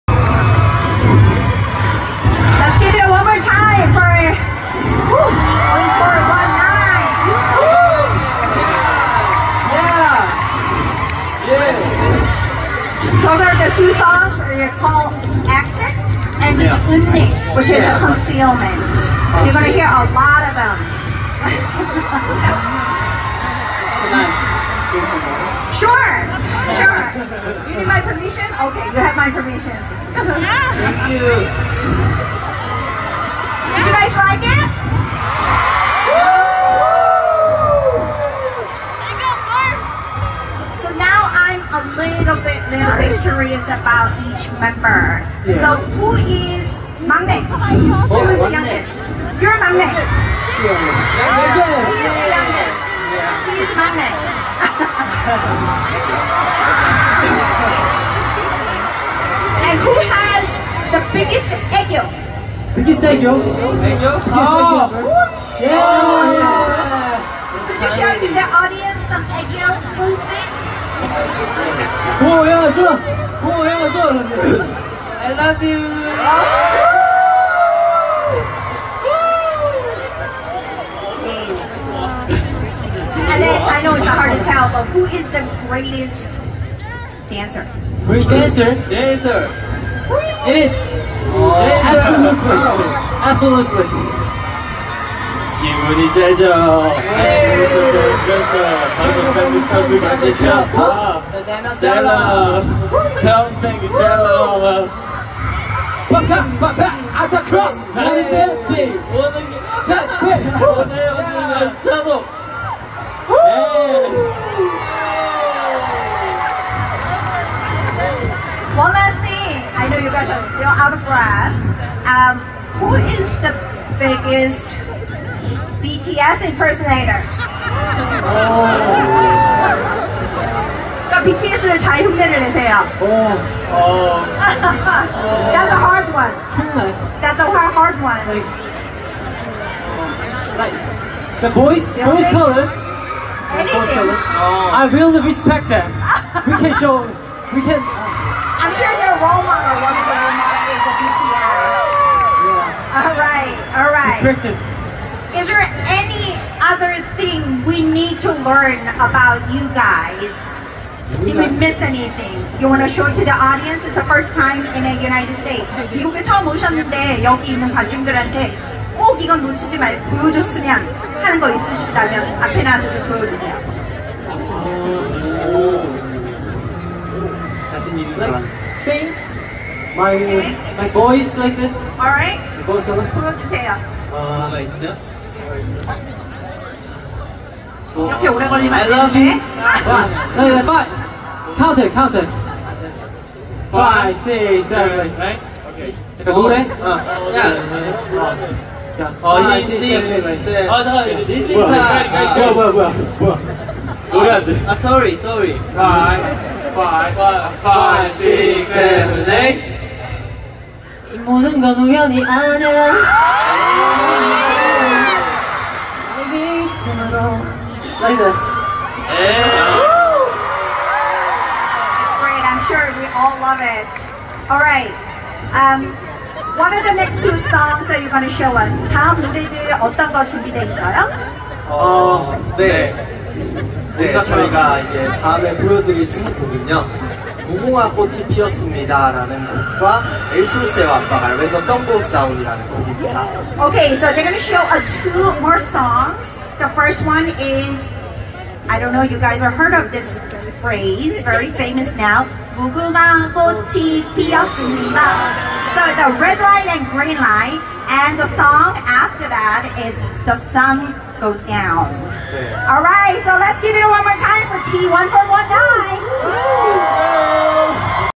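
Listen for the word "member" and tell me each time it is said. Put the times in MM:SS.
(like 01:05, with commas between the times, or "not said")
00:44.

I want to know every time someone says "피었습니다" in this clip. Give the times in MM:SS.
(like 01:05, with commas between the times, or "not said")
03:58.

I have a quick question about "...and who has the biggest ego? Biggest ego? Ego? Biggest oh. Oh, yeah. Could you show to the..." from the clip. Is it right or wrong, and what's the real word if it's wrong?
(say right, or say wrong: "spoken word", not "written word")
right.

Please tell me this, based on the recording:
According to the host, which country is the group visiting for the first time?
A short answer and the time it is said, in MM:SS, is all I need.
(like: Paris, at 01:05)
United States, at 02:45.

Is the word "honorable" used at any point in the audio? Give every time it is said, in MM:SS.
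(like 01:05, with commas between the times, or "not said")
not said.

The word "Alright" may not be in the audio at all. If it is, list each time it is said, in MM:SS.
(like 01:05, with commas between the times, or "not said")
03:01.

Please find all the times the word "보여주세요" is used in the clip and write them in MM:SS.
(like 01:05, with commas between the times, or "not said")
02:53, 03:02.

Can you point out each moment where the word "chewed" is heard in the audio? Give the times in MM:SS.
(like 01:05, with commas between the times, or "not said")
not said.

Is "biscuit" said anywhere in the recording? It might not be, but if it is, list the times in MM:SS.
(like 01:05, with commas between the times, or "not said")
not said.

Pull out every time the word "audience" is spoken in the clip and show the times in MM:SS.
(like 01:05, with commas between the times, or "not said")
01:08, 02:43.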